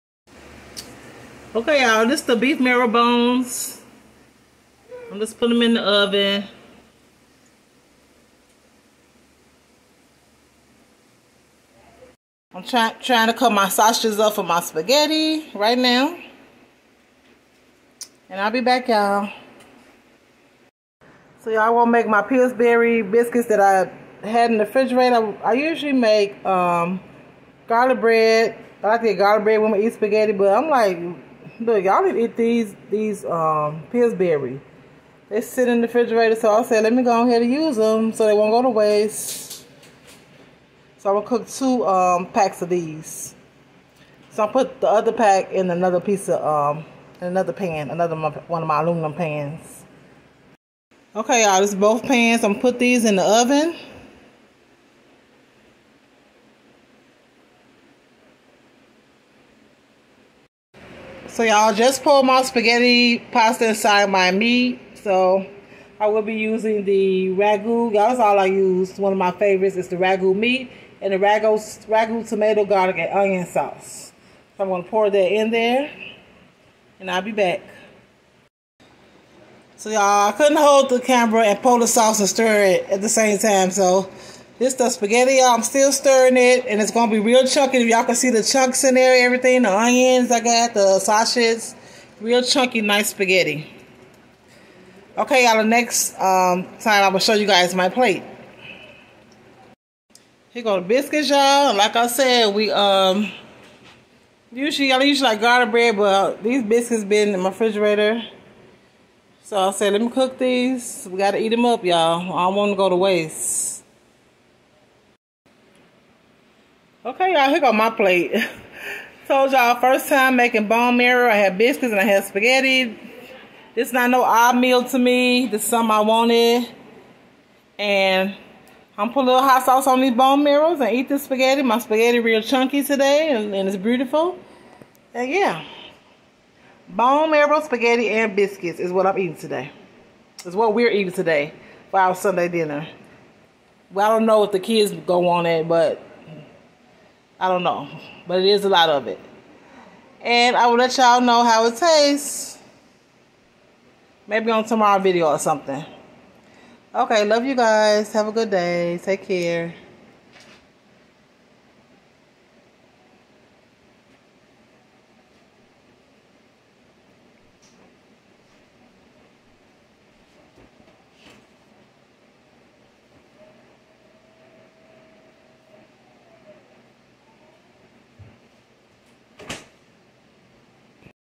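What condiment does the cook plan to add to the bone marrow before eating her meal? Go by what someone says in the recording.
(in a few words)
hot sauce.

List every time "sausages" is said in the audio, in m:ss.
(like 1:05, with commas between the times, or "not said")
0:13, 1:30.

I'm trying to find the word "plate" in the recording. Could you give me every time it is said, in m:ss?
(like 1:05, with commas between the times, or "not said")
1:37, 1:57.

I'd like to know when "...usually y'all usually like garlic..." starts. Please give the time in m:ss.
1:44.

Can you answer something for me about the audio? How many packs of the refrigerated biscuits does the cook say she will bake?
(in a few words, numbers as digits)
2.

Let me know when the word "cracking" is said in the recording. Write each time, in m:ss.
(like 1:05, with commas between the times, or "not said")
not said.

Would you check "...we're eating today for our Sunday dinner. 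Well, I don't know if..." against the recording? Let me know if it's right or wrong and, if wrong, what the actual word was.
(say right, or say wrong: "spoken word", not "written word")
right.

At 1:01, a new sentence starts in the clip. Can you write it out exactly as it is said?
So y'all just pulled my spaghetti pasta inside my meat.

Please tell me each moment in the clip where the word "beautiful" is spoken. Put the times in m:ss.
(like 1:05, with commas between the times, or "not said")
2:13.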